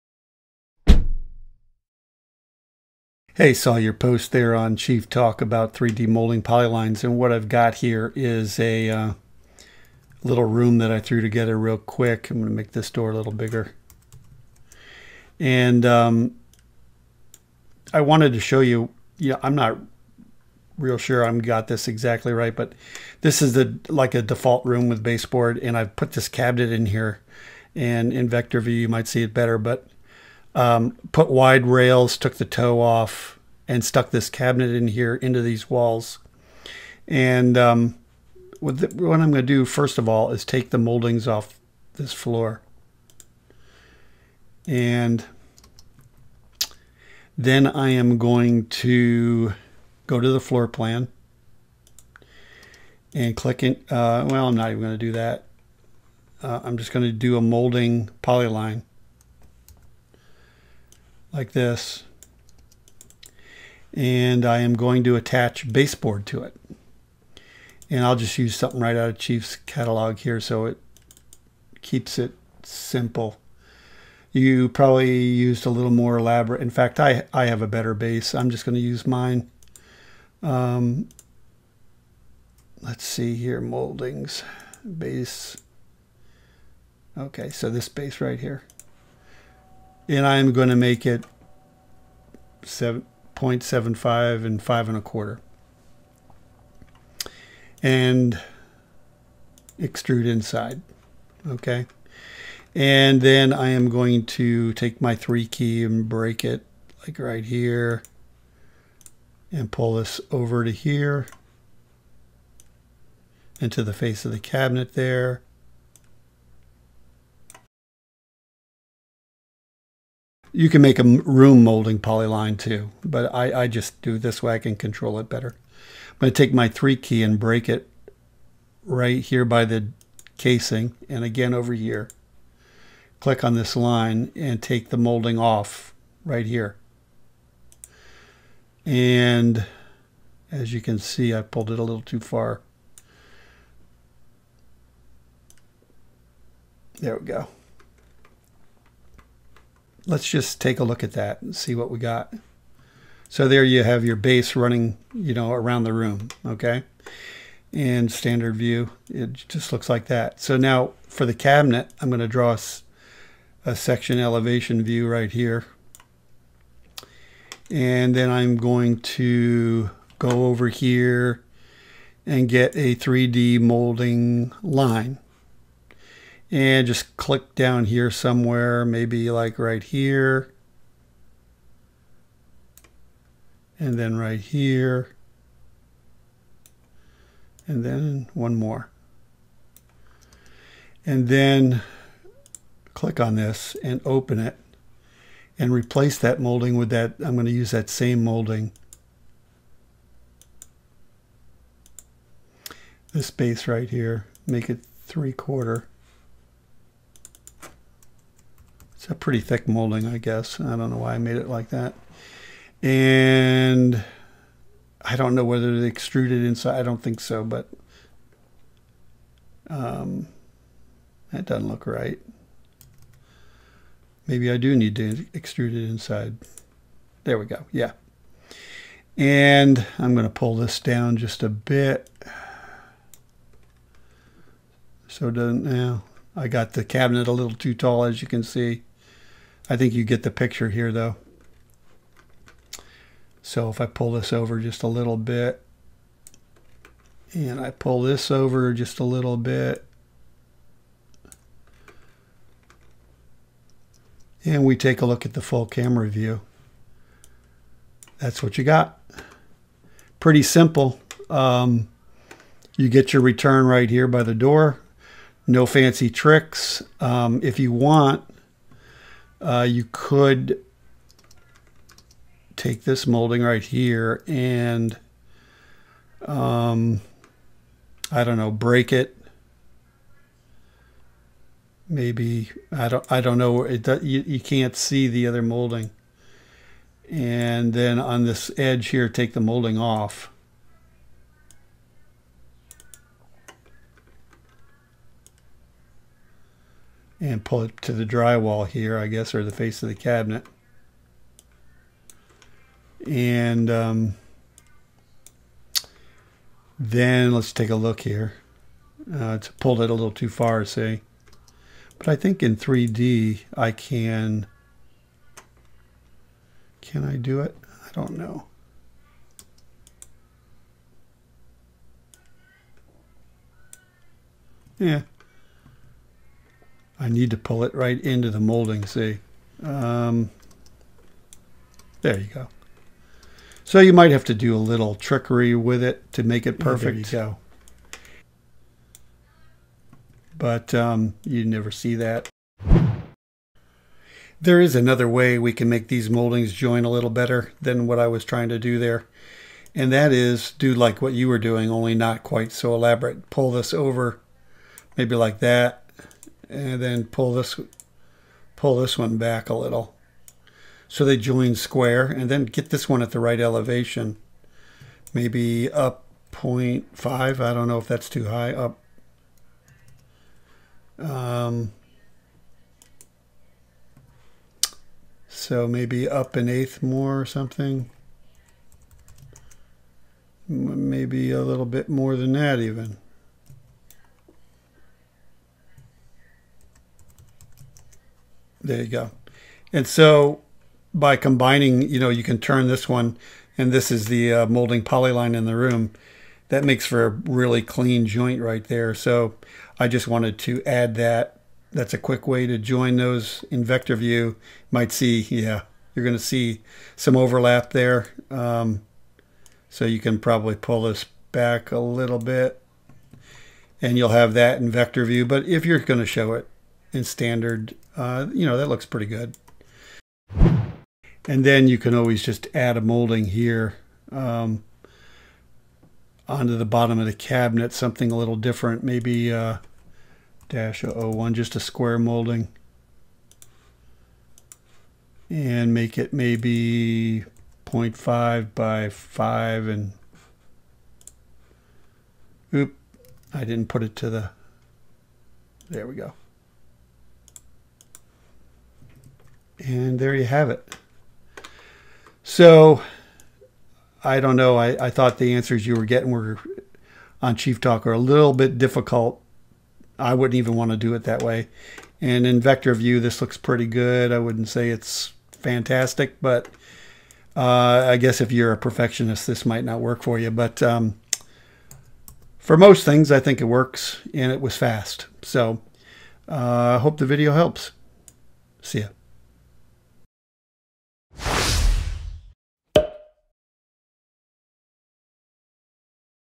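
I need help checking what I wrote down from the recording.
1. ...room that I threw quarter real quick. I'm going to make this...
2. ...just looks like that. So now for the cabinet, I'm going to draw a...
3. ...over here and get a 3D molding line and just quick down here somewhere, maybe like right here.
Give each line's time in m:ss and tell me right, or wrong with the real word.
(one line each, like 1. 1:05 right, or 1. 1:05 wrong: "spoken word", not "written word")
1. 0:10 wrong: "together", not "quarter"
2. 2:39 right
3. 2:50 wrong: "click", not "quick".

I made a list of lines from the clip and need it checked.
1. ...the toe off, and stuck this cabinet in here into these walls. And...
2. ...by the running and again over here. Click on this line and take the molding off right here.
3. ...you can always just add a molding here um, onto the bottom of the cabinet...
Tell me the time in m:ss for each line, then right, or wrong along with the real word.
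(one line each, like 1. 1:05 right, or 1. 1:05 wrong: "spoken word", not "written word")
1. 0:32 right
2. 2:09 wrong: "casing", not "running"
3. 7:01 right.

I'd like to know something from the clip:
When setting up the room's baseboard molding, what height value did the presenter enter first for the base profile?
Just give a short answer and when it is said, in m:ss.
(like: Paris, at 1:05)
7.75, at 1:32.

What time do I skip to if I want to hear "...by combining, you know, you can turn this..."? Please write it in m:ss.
6:30.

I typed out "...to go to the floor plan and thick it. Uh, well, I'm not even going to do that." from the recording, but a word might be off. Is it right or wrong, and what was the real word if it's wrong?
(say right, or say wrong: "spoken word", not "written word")
wrong: "click", not "thick".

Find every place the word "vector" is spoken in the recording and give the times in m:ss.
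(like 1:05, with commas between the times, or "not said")
0:28, 6:43, 6:54, 7:42.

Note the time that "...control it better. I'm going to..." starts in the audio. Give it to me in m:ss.
2:04.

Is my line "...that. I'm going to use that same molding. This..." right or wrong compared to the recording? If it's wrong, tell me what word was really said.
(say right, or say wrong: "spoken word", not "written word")
right.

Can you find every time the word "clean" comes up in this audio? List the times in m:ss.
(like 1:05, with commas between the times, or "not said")
6:37.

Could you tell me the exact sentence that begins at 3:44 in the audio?
Maybe I do need to extrude it inside.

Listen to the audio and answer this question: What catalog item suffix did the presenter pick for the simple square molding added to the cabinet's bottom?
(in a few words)
dash 001.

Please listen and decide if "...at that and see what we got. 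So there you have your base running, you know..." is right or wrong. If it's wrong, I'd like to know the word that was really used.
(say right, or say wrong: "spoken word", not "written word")
right.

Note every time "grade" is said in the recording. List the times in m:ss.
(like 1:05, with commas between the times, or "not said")
not said.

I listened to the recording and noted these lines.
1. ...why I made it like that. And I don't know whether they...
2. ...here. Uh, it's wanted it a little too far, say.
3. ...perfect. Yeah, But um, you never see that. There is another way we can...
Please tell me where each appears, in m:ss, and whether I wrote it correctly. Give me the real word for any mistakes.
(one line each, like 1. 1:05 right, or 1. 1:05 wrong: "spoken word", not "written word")
1. 3:30 right
2. 5:08 wrong: "pulled", not "wanted"
3. 5:36 right.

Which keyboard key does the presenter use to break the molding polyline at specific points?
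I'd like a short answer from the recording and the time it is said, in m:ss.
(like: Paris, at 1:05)
3, at 1:45.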